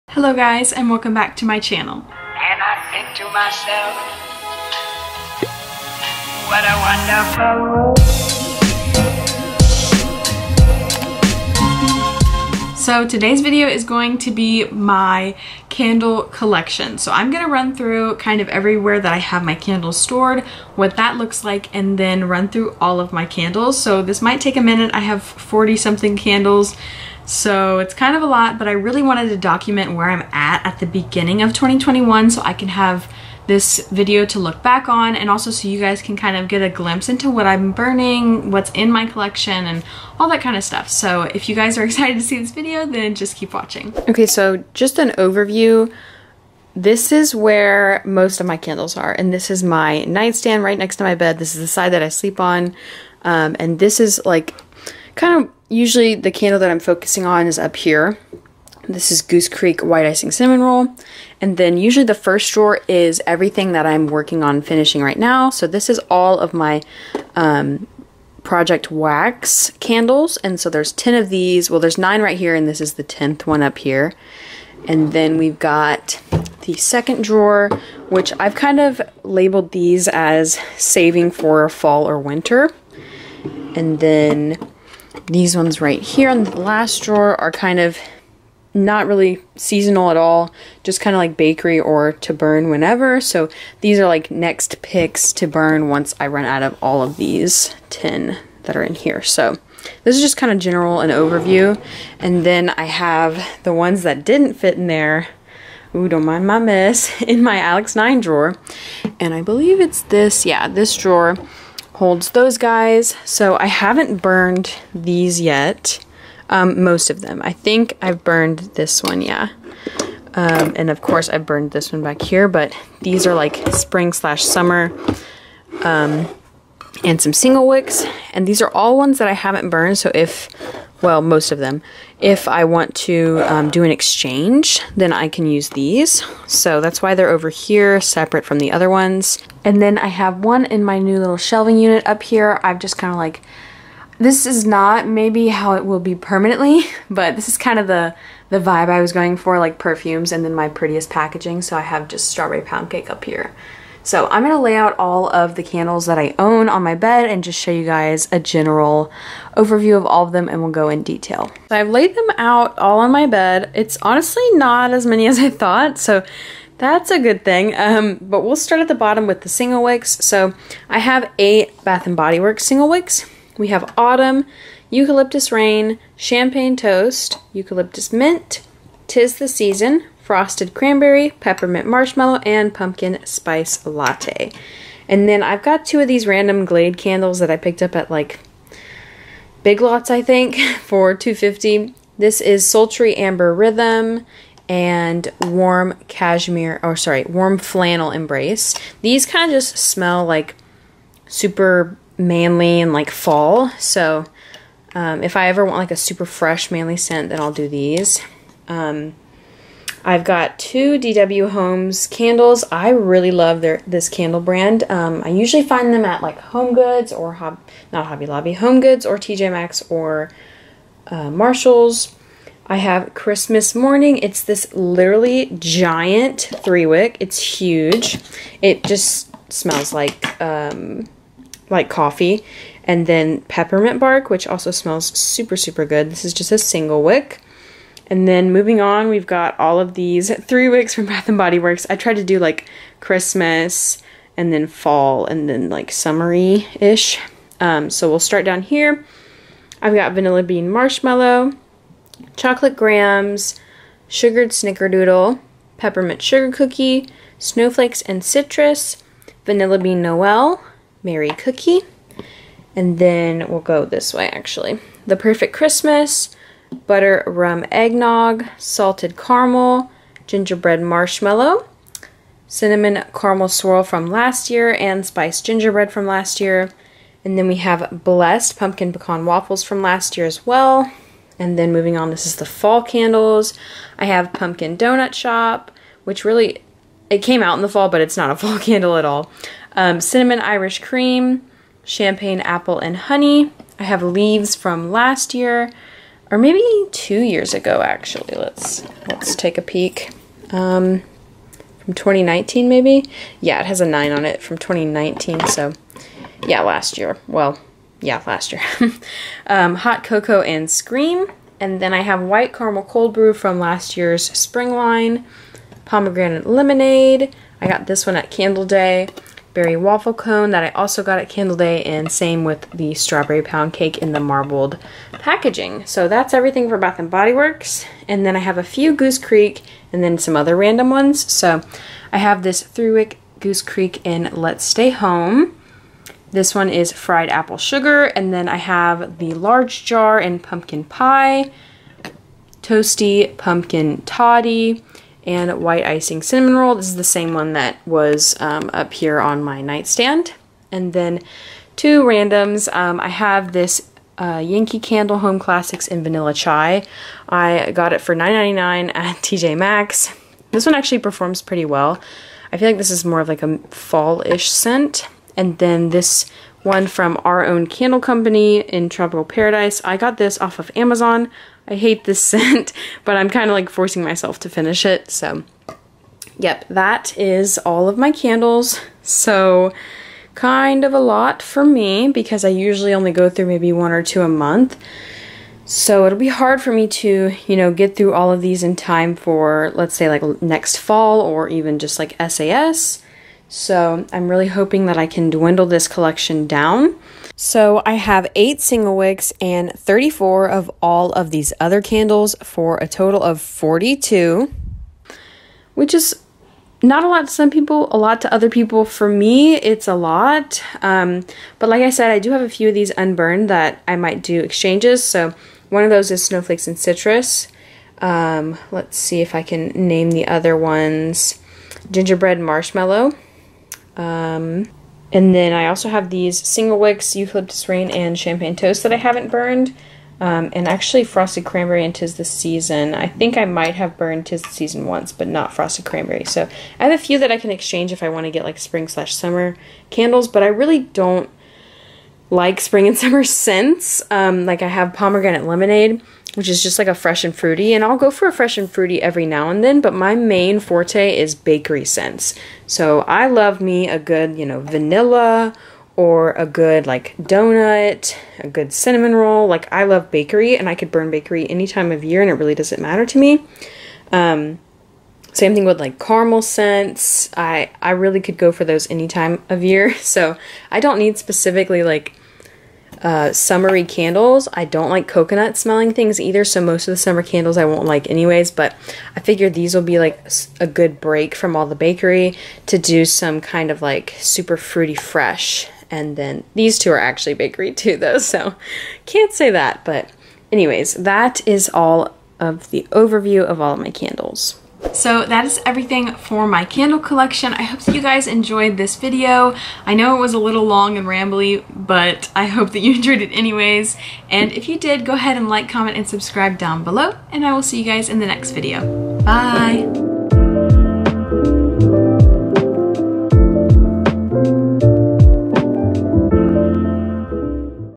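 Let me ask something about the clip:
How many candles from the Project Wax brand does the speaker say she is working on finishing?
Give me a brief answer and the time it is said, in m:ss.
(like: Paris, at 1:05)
10, at 1:10.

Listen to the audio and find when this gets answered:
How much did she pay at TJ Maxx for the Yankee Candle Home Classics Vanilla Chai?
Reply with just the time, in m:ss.
5:58.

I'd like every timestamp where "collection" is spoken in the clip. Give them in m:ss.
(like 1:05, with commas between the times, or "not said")
0:16, 0:39, 6:35, 8:16.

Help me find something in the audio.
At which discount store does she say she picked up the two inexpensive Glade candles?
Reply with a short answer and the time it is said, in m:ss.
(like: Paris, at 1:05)
Big Lots, at 3:09.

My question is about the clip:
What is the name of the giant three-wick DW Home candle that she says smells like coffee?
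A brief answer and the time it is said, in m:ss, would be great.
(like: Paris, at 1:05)
Christmas Morning, at 3:43.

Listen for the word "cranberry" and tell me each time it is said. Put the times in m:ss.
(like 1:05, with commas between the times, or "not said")
3:00, 7:11, 7:15.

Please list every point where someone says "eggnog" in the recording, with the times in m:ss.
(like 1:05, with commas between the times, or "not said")
4:27.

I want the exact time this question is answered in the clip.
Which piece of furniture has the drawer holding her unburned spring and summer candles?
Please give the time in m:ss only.
1:47.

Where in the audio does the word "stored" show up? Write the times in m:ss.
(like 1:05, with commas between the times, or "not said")
0:19.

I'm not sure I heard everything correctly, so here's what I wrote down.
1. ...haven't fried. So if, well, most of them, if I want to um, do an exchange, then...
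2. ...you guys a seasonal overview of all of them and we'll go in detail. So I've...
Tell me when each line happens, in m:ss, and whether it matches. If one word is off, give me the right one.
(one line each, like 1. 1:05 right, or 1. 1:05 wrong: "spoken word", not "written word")
1. 2:09 wrong: "burned", not "fried"
2. 2:37 wrong: "general", not "seasonal".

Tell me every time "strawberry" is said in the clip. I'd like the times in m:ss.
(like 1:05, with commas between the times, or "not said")
2:32, 5:22.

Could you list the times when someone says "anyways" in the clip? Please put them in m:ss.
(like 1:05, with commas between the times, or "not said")
7:58, 8:10, 8:23.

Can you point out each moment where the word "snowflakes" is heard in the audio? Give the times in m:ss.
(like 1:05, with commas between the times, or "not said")
4:17, 6:56.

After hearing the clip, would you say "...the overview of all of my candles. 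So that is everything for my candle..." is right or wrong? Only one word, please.
right.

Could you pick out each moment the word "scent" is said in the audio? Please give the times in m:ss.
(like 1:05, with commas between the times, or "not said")
3:26, 6:04, 6:12, 7:23, 7:31, 7:46.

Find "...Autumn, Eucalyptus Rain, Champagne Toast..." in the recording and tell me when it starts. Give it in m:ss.
2:53.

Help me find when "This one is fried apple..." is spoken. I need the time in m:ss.
5:36.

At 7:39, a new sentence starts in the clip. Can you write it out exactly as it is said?
Like I love bakery and I could burn bakery any time of year and it really doesn't matter to me.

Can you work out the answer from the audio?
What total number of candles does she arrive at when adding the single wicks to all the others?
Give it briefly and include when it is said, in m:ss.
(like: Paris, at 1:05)
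42, at 6:43.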